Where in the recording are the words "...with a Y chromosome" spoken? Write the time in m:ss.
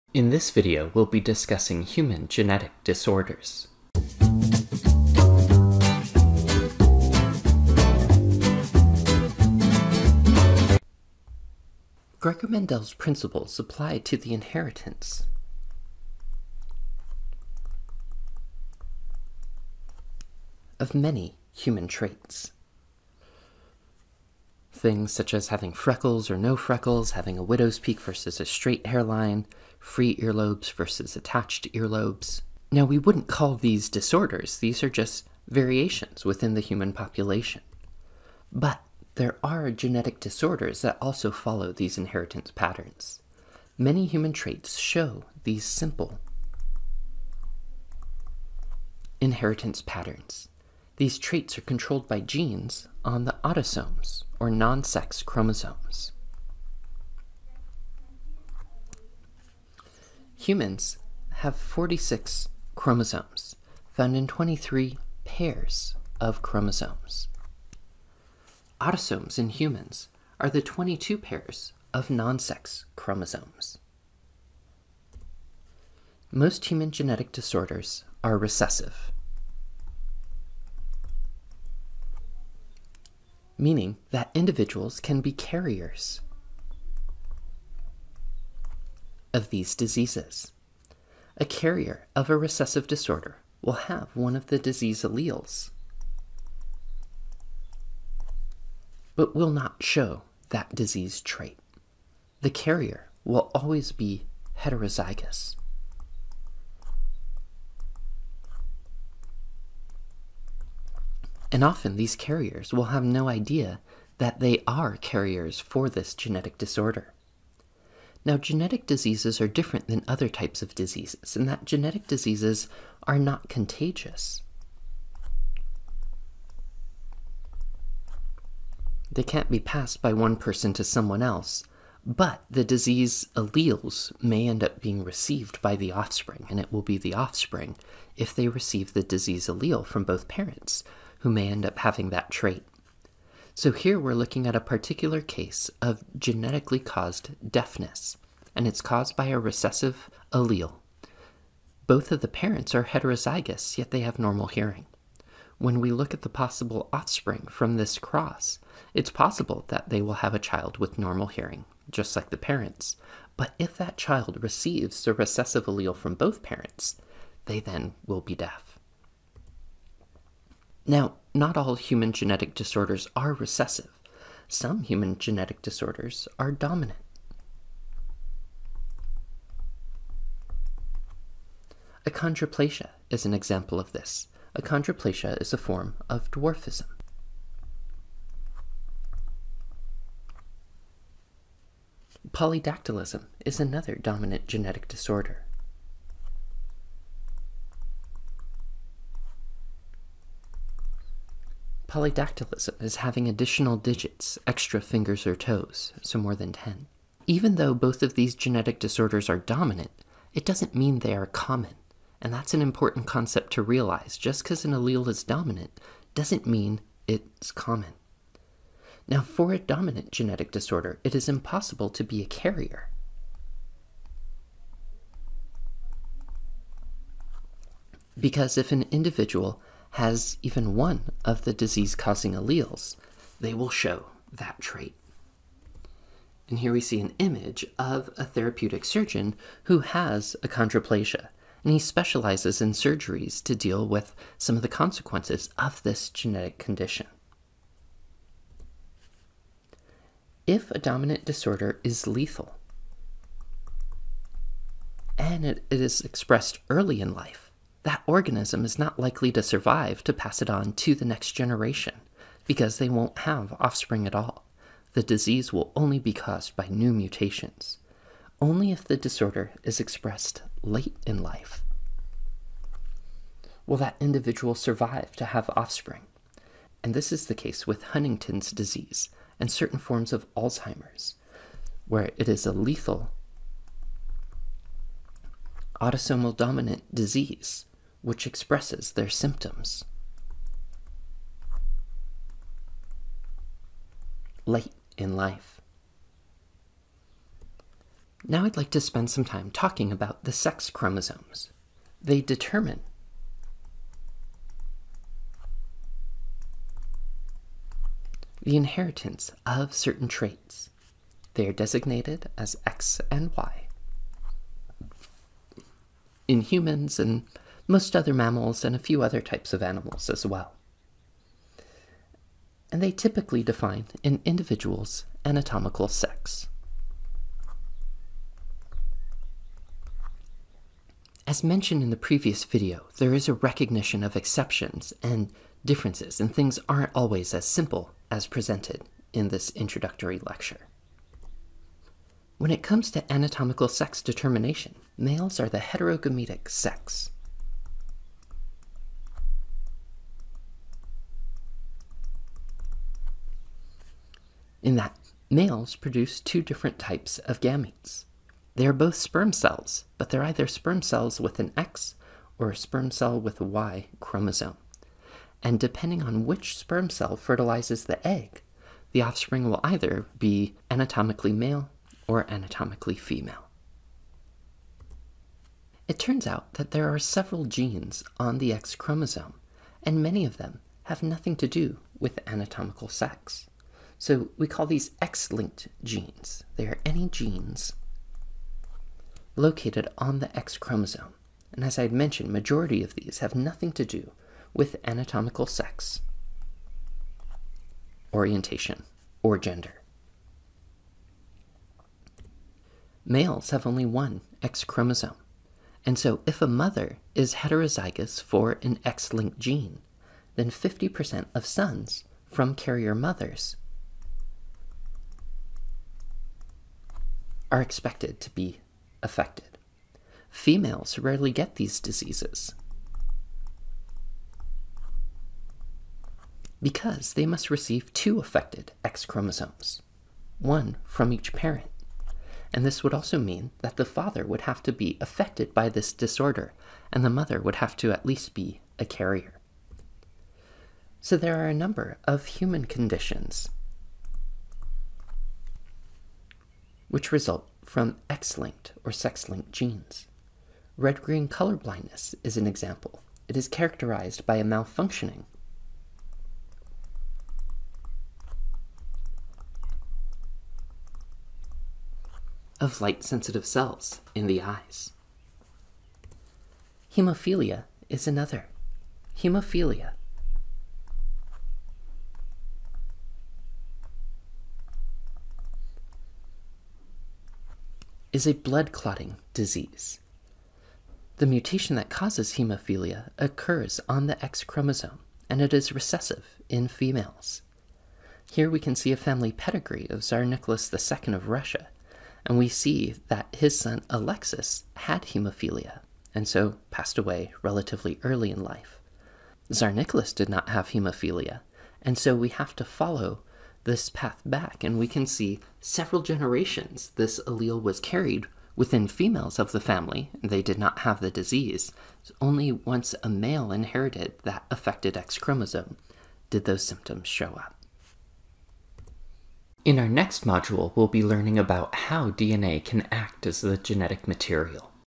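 6:03.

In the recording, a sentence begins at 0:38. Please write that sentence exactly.
But there are genetic disorders that also follow these inheritance patterns.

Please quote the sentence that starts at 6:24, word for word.
So we call these X-linked genes.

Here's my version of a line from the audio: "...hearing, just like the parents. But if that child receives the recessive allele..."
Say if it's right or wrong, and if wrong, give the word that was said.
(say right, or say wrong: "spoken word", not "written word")
right.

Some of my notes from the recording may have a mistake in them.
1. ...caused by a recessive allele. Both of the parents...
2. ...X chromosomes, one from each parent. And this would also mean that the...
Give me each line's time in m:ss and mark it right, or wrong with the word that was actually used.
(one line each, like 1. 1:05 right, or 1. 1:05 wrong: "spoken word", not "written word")
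1. 2:28 right
2. 7:08 right.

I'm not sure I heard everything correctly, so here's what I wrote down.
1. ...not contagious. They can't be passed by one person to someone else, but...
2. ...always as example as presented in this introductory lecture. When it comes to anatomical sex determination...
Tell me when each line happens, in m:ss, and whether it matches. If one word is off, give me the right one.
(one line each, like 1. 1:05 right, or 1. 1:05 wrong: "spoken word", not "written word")
1. 2:03 right
2. 5:36 wrong: "simple", not "example".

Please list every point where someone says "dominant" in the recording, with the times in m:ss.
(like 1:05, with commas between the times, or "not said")
2:56, 3:13, 3:29, 3:35, 3:39, 4:10, 4:46.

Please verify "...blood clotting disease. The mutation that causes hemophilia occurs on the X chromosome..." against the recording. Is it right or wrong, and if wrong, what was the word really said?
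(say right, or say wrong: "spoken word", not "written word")
right.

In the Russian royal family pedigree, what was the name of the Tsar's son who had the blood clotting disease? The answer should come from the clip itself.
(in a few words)
Alexis.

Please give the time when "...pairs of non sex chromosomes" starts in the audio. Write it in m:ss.
1:11.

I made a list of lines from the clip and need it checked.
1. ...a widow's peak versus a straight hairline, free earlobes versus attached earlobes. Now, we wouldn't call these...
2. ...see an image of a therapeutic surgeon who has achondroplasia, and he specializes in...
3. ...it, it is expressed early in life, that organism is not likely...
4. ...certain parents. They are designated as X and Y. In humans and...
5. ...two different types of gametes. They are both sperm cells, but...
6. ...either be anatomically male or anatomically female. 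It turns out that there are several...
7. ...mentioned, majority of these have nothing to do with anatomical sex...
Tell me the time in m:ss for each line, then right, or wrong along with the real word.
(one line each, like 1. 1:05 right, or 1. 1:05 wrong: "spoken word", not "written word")
1. 0:27 right
2. 3:56 right
3. 4:15 right
4. 5:09 wrong: "traits", not "parents"
5. 5:56 right
6. 6:09 right
7. 6:31 right.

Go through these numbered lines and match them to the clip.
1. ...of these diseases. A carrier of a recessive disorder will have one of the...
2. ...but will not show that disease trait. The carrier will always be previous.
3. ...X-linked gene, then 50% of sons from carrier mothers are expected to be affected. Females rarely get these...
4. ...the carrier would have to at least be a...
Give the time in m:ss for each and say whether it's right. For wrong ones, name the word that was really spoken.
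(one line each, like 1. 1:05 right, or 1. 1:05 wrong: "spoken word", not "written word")
1. 1:29 right
2. 1:39 wrong: "heterozygous", not "previous"
3. 6:48 right
4. 7:17 wrong: "mother", not "carrier".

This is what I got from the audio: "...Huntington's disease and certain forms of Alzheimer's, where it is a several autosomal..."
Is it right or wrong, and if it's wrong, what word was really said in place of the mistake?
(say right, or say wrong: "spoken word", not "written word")
wrong: "lethal", not "several".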